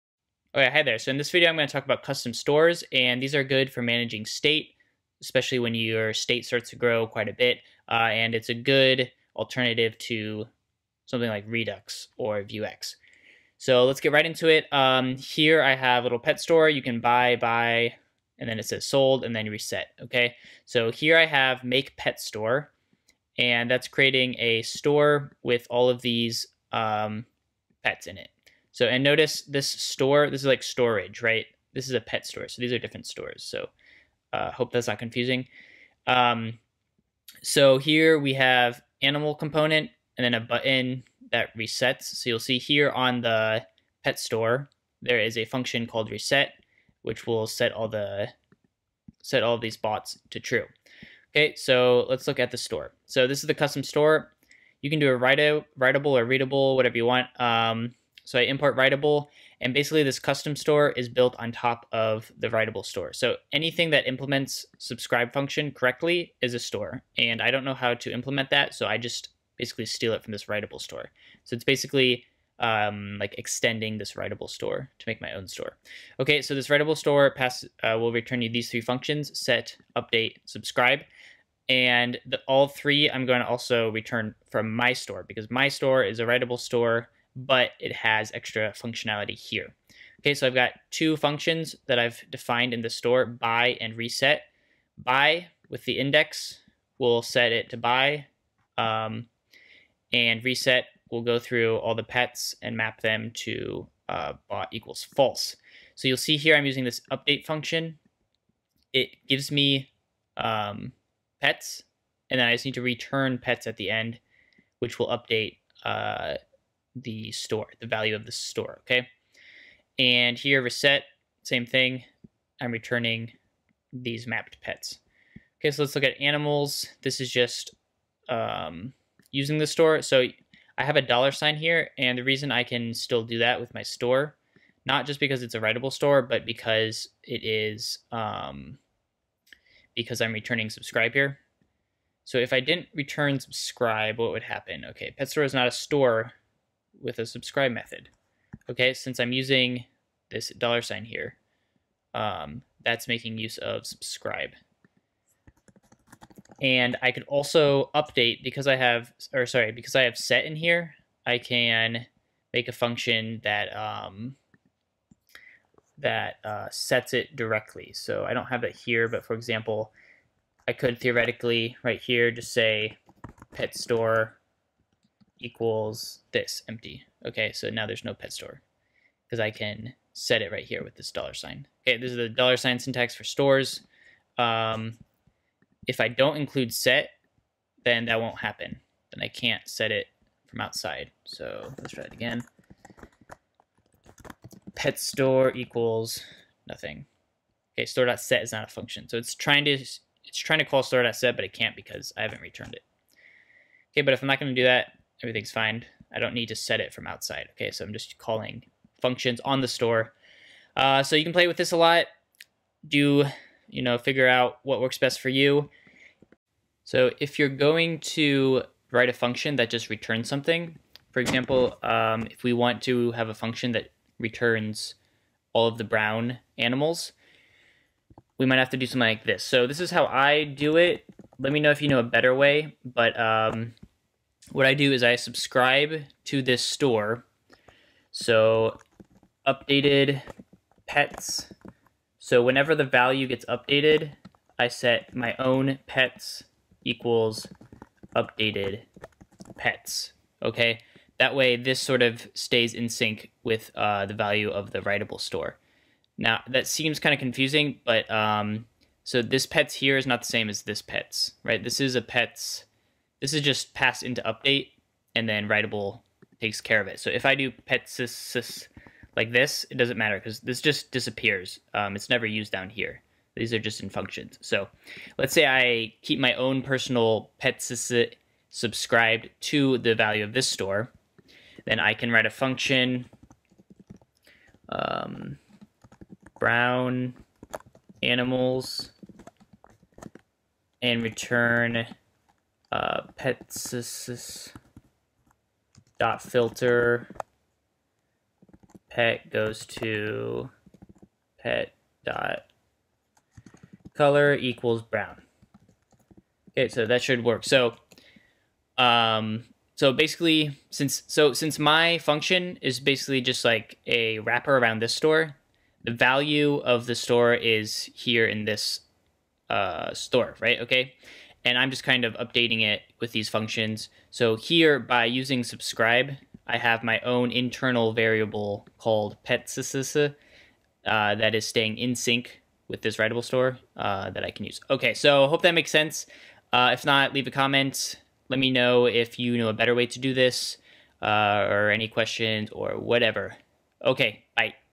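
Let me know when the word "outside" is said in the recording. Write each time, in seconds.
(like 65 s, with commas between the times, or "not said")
190 s, 207 s.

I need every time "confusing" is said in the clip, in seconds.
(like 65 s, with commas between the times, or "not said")
34 s, 257 s.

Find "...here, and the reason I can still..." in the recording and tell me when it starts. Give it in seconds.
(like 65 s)
131 s.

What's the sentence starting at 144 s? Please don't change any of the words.
Okay, pet store is not a store, with a subscribe method.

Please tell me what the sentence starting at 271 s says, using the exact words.
Um, it's never used down here.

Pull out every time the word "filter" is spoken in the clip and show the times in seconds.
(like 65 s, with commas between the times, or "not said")
296 s.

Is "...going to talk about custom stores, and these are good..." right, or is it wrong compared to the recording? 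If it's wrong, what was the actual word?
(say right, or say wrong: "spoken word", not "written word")
right.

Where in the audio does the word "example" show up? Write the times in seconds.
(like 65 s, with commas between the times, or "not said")
169 s, 221 s.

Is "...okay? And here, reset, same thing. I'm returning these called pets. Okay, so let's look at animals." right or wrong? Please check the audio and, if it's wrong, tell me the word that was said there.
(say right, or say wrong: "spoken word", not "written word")
wrong: "mapped", not "called".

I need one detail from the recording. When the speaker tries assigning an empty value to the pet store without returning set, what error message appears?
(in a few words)
store.set is not a function.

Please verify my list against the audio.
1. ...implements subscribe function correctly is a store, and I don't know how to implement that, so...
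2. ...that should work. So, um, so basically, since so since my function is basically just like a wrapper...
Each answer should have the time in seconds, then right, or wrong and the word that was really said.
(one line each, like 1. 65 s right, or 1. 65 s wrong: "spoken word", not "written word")
1. 64 s right
2. 306 s right.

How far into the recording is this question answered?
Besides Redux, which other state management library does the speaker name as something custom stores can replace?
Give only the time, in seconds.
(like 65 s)
12 s.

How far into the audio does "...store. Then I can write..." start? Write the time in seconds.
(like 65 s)
280 s.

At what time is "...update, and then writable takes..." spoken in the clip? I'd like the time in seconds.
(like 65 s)
264 s.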